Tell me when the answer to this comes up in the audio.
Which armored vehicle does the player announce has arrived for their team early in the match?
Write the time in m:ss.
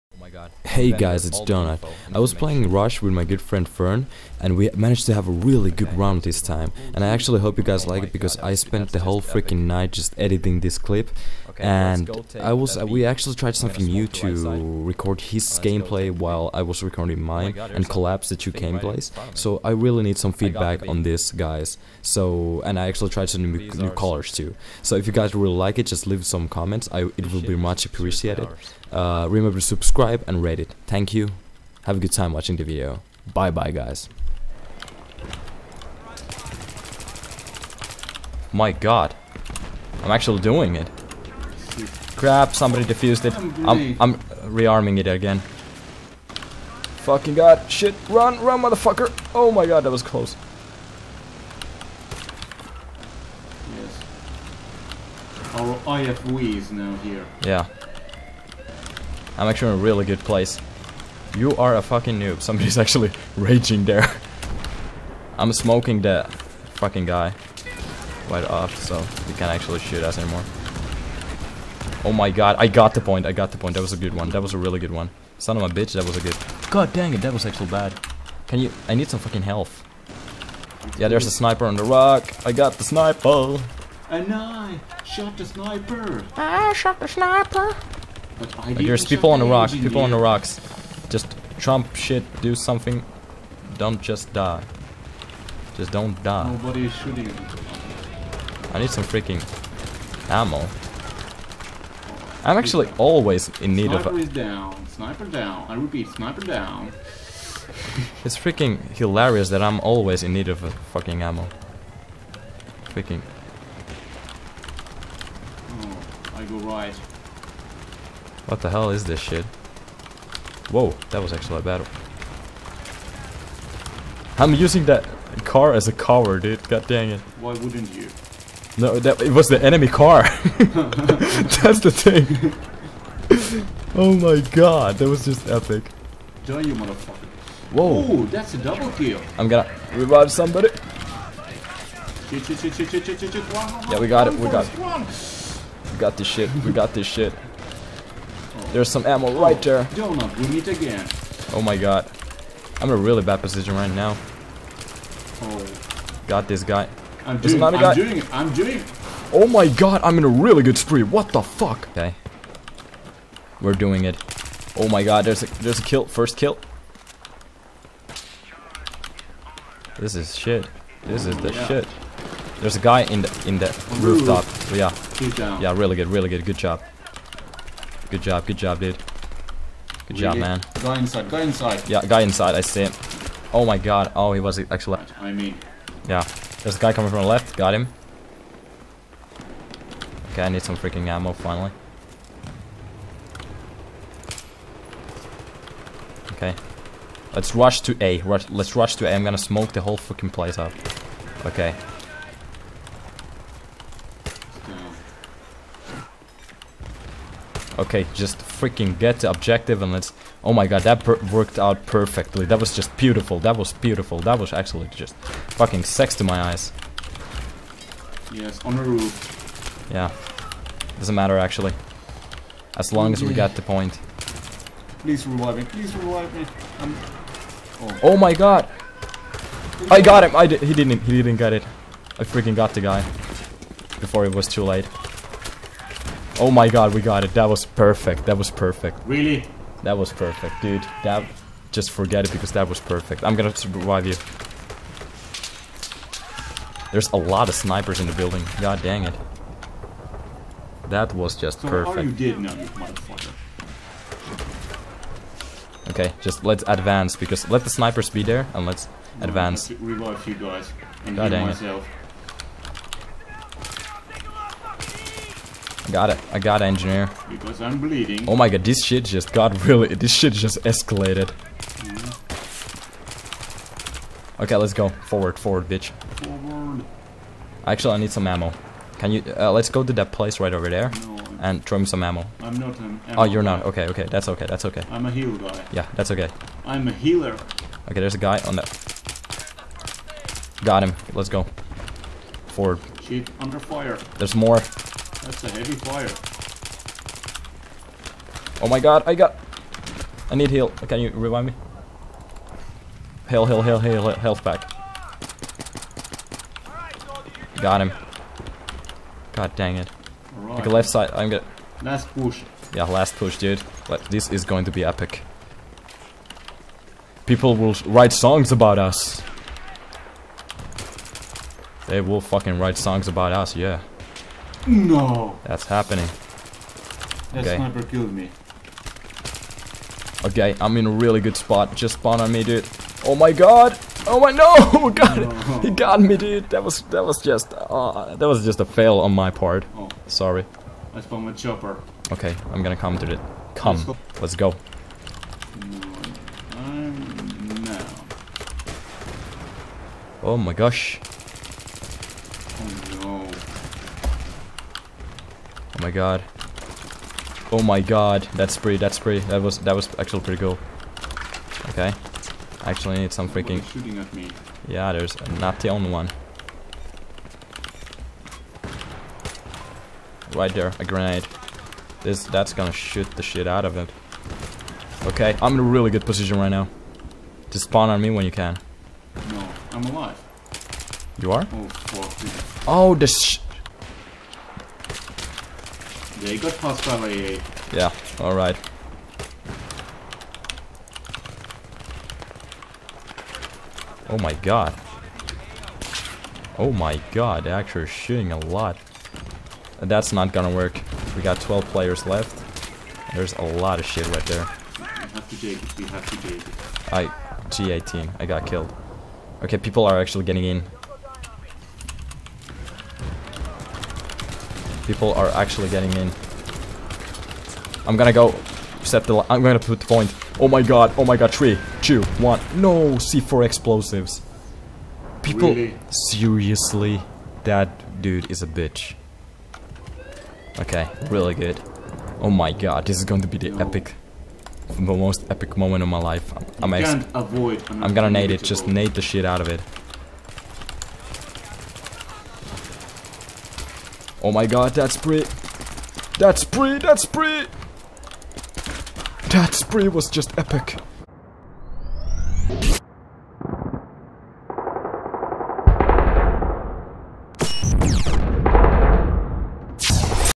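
0:55.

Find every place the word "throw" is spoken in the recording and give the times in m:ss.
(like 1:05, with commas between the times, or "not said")
4:41.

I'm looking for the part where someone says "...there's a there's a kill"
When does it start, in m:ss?
2:45.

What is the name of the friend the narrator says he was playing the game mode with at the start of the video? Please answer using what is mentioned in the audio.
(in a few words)
Fern.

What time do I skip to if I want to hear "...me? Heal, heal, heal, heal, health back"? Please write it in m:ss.
5:01.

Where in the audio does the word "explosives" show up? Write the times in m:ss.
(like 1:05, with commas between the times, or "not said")
7:03.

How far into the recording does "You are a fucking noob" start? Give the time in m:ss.
1:01.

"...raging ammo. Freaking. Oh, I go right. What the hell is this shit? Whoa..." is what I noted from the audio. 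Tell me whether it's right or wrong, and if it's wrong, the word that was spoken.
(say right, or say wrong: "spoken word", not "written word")
wrong: "fucking", not "raging".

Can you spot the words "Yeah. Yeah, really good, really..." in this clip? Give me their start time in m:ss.
2:54.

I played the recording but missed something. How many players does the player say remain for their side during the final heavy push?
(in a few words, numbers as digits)
12.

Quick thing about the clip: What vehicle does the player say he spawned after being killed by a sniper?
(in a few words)
Chopper.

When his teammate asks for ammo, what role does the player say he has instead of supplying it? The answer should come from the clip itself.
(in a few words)
Healer.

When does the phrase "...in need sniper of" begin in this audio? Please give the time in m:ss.
1:43.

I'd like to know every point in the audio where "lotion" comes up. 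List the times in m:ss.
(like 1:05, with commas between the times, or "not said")
not said.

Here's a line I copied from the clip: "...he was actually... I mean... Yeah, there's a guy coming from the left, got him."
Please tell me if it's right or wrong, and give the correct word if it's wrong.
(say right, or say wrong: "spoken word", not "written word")
right.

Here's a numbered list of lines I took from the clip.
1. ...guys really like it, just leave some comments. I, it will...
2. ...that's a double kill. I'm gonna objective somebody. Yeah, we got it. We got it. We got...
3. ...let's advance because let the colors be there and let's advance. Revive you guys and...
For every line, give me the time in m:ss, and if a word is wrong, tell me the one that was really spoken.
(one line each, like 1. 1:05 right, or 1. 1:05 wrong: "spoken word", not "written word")
1. 0:25 right
2. 2:18 wrong: "revive", not "objective"
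3. 4:16 wrong: "snipers", not "colors".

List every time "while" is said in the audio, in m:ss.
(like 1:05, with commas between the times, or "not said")
0:16.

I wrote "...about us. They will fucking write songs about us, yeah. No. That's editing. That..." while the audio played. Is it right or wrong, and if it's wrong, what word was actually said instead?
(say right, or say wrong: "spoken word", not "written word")
wrong: "happening", not "editing".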